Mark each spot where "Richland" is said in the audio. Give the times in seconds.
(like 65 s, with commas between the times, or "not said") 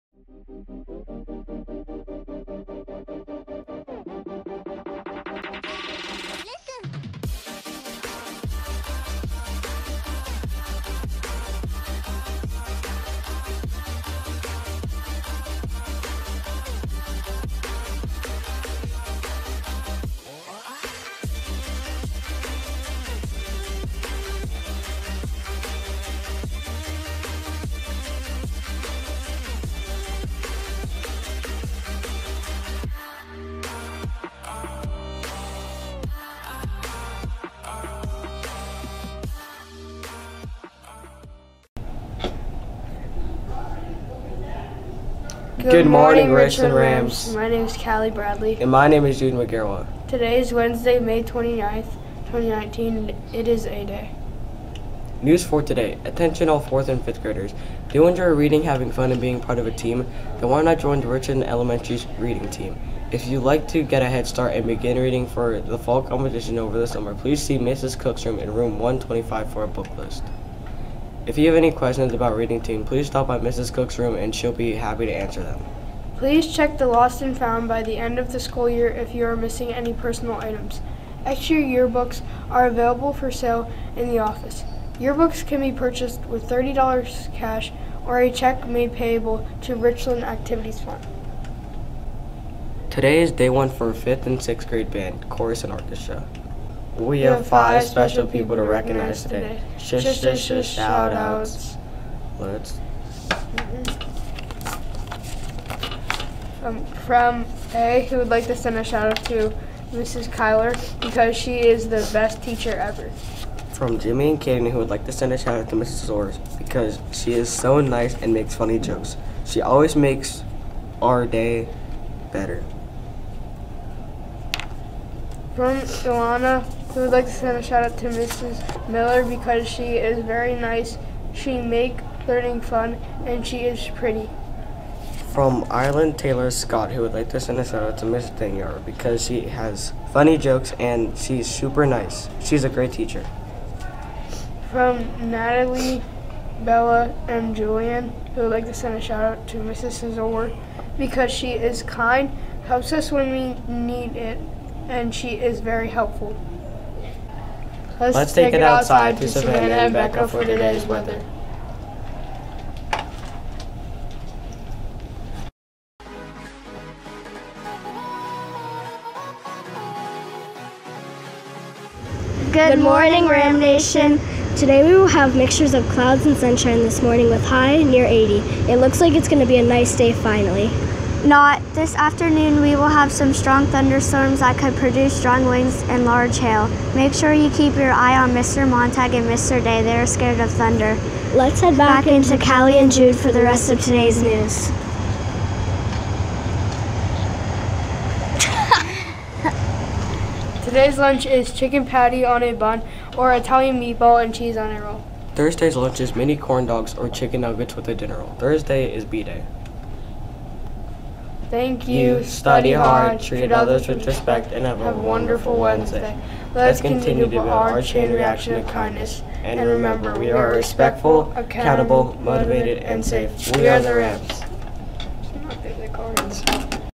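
46 s, 61 s, 89 s.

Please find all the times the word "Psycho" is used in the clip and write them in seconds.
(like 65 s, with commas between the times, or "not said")
not said.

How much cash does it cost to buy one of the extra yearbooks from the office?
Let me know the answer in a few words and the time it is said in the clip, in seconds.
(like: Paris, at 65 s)
$30, at 86 s.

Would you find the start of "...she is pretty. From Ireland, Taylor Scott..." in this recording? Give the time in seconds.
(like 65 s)
133 s.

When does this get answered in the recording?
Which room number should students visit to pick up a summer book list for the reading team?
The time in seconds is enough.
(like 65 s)
68 s.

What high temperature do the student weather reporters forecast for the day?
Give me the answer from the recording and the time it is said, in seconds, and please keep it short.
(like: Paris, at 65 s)
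80, at 178 s.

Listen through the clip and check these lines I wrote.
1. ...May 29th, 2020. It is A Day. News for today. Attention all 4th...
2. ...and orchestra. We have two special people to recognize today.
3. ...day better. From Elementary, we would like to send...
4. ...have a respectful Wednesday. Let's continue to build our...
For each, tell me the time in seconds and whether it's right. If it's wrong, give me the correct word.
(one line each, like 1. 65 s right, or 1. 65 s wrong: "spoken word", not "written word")
1. 50 s wrong: "2019", not "2020"
2. 95 s wrong: "five", not "two"
3. 121 s wrong: "Ilana", not "Elementary"
4. 214 s wrong: "wonderful", not "respectful".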